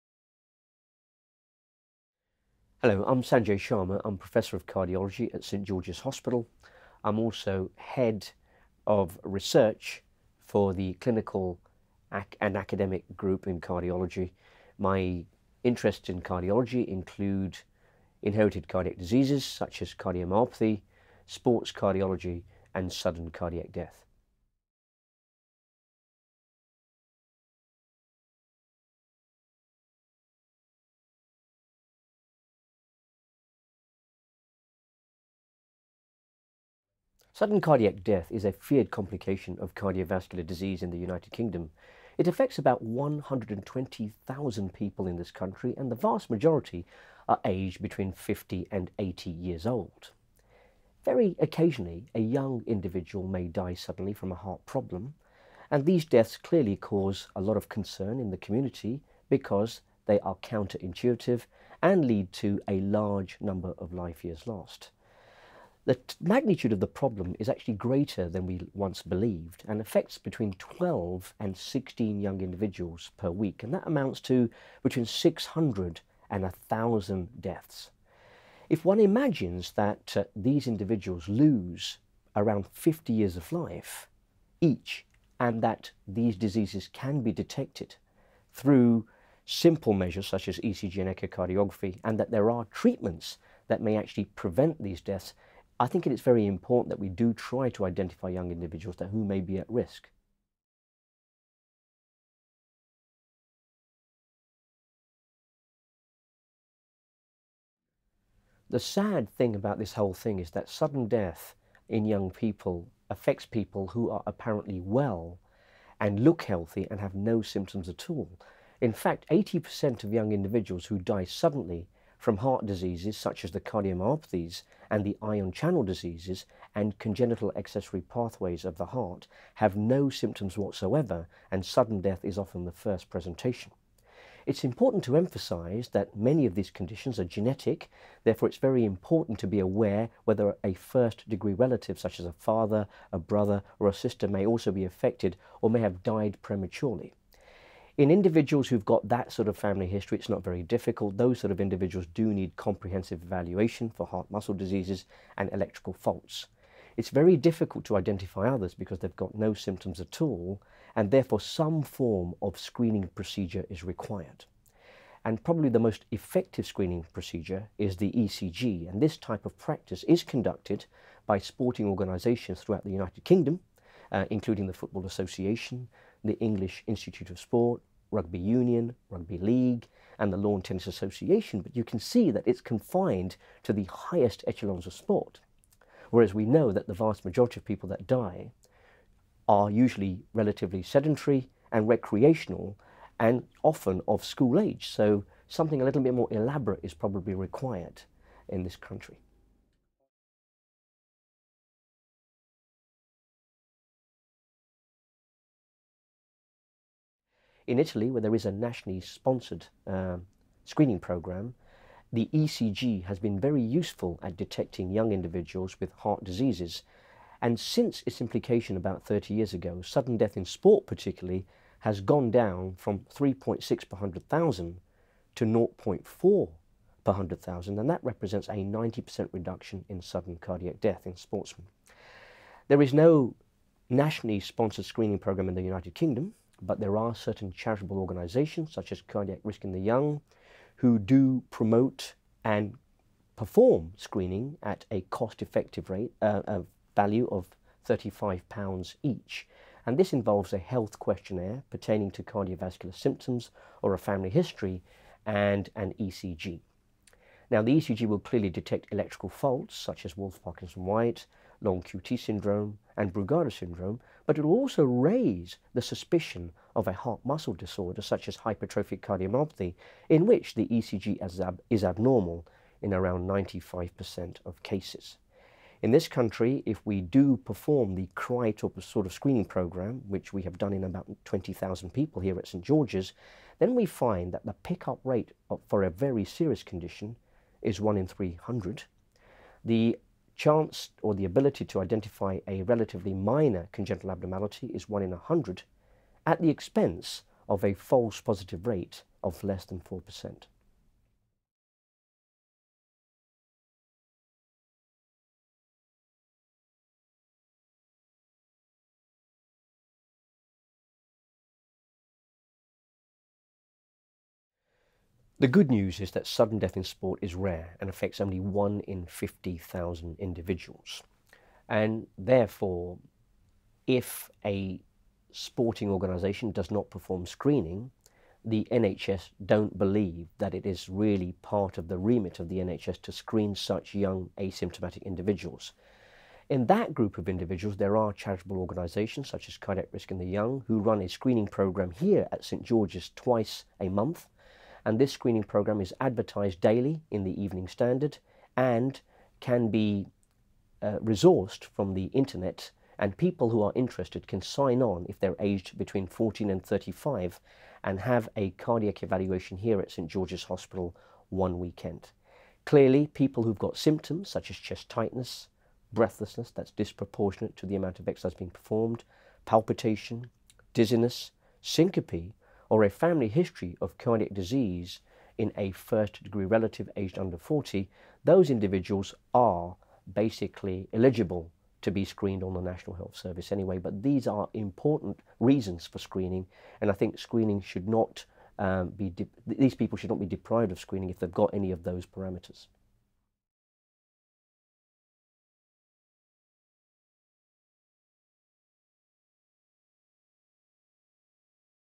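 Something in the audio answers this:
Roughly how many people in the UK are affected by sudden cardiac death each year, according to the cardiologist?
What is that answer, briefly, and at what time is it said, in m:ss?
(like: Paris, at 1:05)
120,000, at 0:42.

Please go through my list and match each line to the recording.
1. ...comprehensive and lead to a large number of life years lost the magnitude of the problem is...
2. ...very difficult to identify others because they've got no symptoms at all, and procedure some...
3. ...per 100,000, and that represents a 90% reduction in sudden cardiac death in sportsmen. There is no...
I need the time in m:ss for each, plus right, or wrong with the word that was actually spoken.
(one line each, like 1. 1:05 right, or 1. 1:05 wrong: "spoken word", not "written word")
1. 1:00 wrong: "counterintuitive", not "comprehensive"
2. 2:37 wrong: "therefore", not "procedure"
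3. 3:47 right.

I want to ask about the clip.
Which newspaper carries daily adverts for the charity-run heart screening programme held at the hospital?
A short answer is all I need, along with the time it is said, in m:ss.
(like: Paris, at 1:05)
Evening Standard, at 5:47.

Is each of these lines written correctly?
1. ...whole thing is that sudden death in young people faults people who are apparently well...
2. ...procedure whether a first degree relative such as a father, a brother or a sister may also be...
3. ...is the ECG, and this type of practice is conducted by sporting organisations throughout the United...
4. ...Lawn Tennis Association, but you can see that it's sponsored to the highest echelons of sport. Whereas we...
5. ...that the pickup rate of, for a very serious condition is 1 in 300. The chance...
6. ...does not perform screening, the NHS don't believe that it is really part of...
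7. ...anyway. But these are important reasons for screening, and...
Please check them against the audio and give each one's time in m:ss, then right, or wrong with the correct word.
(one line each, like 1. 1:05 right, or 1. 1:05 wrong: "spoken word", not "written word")
1. 1:49 wrong: "affects", not "faults"
2. 2:19 wrong: "aware", not "procedure"
3. 2:47 right
4. 3:00 wrong: "confined", not "sponsored"
5. 4:44 right
6. 5:26 right
7. 6:23 right.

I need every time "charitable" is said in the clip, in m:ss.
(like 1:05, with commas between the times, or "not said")
3:57, 5:38.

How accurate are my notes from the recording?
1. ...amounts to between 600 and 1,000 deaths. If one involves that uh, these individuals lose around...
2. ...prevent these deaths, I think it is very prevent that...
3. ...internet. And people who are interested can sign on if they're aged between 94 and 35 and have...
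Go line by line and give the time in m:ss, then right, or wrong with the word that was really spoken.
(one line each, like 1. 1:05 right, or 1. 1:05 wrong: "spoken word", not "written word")
1. 1:13 wrong: "imagines", not "involves"
2. 1:34 wrong: "important", not "prevent"
3. 5:52 wrong: "14", not "94".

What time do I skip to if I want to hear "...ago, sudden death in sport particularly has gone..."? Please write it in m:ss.
3:39.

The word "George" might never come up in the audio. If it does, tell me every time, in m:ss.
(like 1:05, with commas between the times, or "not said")
0:05, 4:42, 5:42, 6:00.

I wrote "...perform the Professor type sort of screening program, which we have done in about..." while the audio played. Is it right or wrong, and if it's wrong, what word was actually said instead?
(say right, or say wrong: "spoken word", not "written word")
wrong: "CRY", not "Professor".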